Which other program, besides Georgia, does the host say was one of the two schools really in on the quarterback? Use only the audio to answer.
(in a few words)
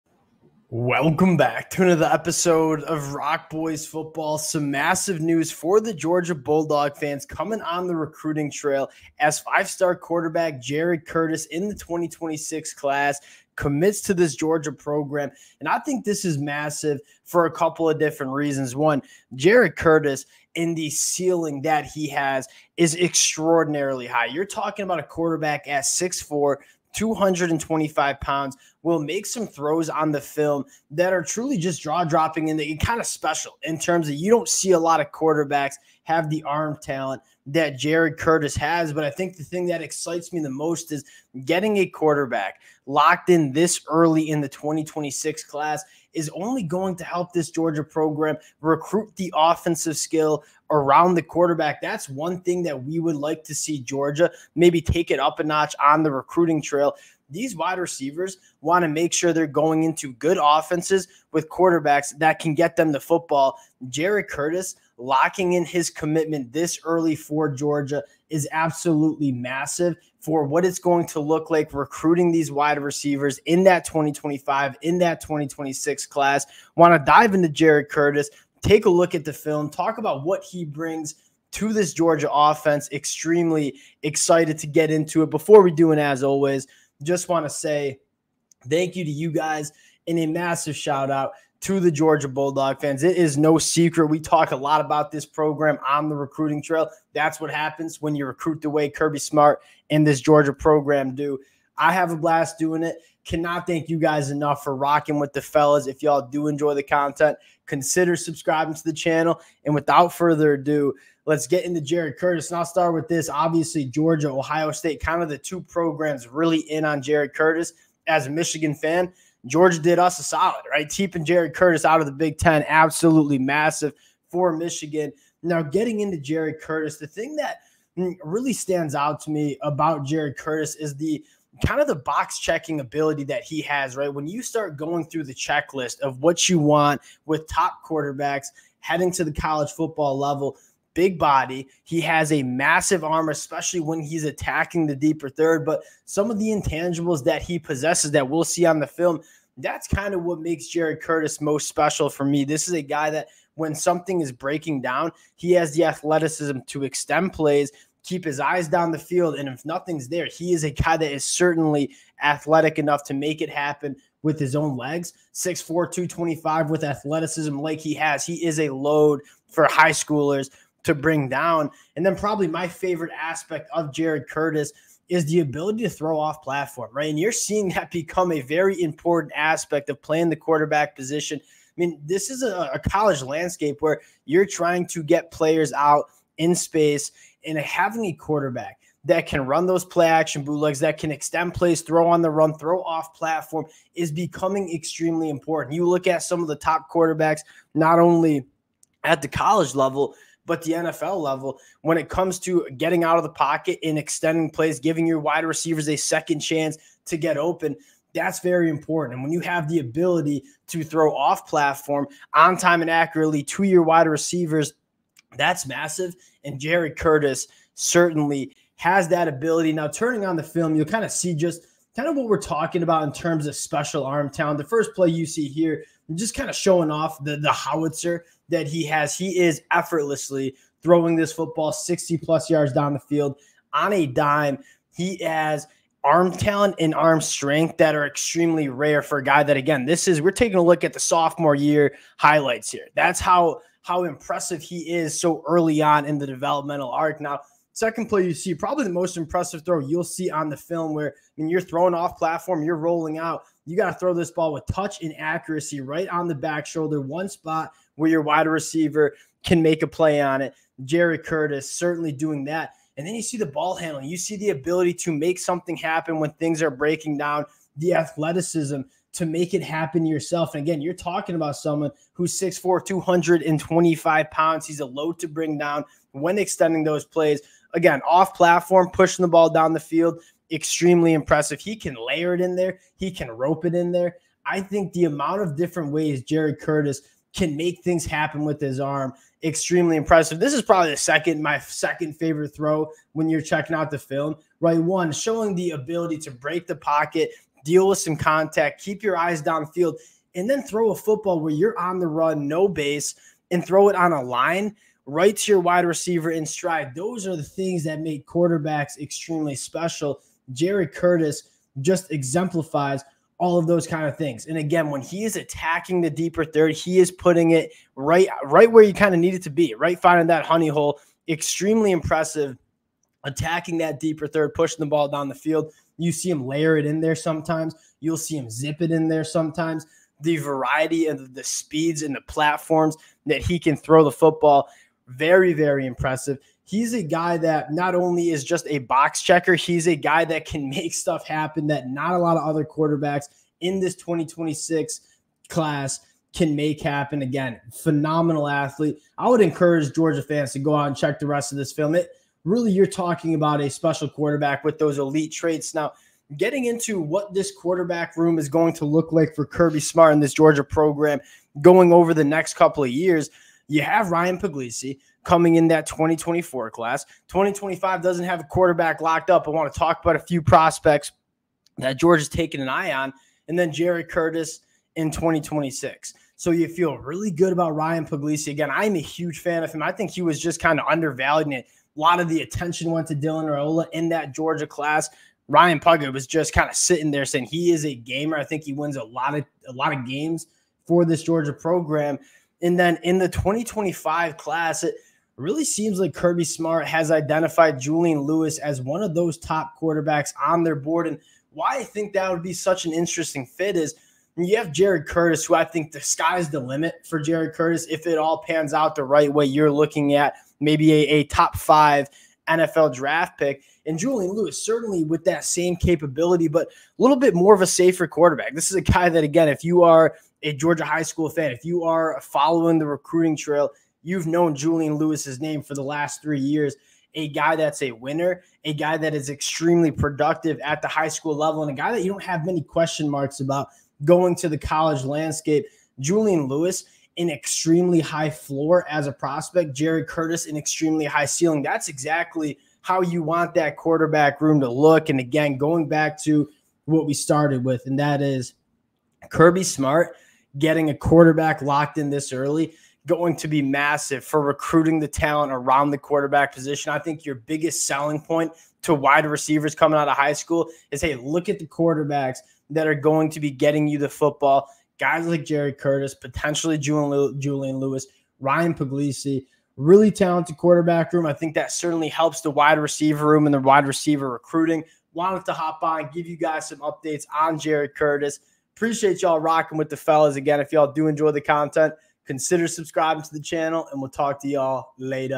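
Ohio State.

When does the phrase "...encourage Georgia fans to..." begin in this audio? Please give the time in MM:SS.
05:49.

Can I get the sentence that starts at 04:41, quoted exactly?
He can layer it in there, he can rope it in there.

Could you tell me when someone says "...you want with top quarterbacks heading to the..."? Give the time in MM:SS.
02:16.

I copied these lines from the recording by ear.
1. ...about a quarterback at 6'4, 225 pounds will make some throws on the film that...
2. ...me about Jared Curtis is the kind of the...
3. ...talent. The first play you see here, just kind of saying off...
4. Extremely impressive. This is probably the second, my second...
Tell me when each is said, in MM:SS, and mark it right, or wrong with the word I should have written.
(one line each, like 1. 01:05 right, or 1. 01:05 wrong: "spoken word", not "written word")
1. 00:24 right
2. 02:09 right
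3. 03:44 wrong: "showing", not "saying"
4. 04:49 right.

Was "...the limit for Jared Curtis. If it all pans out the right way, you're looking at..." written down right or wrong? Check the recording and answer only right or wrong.
right.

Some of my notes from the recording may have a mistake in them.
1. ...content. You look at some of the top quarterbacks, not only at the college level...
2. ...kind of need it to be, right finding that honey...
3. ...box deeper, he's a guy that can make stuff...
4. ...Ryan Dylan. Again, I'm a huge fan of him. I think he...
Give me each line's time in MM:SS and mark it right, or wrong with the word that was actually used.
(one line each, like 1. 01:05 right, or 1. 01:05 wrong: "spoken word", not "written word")
1. 03:15 wrong: "important", not "content"
2. 05:18 right
3. 05:38 wrong: "checker", not "deeper"
4. 06:17 wrong: "Puglisi", not "Dylan".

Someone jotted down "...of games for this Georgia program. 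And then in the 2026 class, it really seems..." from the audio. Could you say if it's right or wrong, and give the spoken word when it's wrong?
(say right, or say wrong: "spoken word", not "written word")
wrong: "2025", not "2026".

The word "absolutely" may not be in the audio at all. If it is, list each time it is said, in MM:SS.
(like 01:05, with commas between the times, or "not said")
01:08, 02:02.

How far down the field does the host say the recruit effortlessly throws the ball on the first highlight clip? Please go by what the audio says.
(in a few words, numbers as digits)
60 plus yards.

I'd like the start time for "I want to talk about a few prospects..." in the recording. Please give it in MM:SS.
06:09.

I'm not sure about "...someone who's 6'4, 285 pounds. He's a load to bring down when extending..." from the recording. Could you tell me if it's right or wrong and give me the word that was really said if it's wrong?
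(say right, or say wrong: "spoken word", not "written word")
wrong: "225", not "285".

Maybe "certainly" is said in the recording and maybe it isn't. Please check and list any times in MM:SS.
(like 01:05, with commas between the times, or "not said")
02:41, 03:37, 04:21, 06:54, 07:51.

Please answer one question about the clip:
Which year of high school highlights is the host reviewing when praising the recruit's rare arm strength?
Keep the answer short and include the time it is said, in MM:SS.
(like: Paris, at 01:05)
sophomore year, at 04:00.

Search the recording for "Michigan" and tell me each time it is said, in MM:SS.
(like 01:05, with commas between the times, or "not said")
01:58, 02:04.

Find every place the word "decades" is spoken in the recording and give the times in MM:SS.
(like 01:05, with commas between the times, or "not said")
not said.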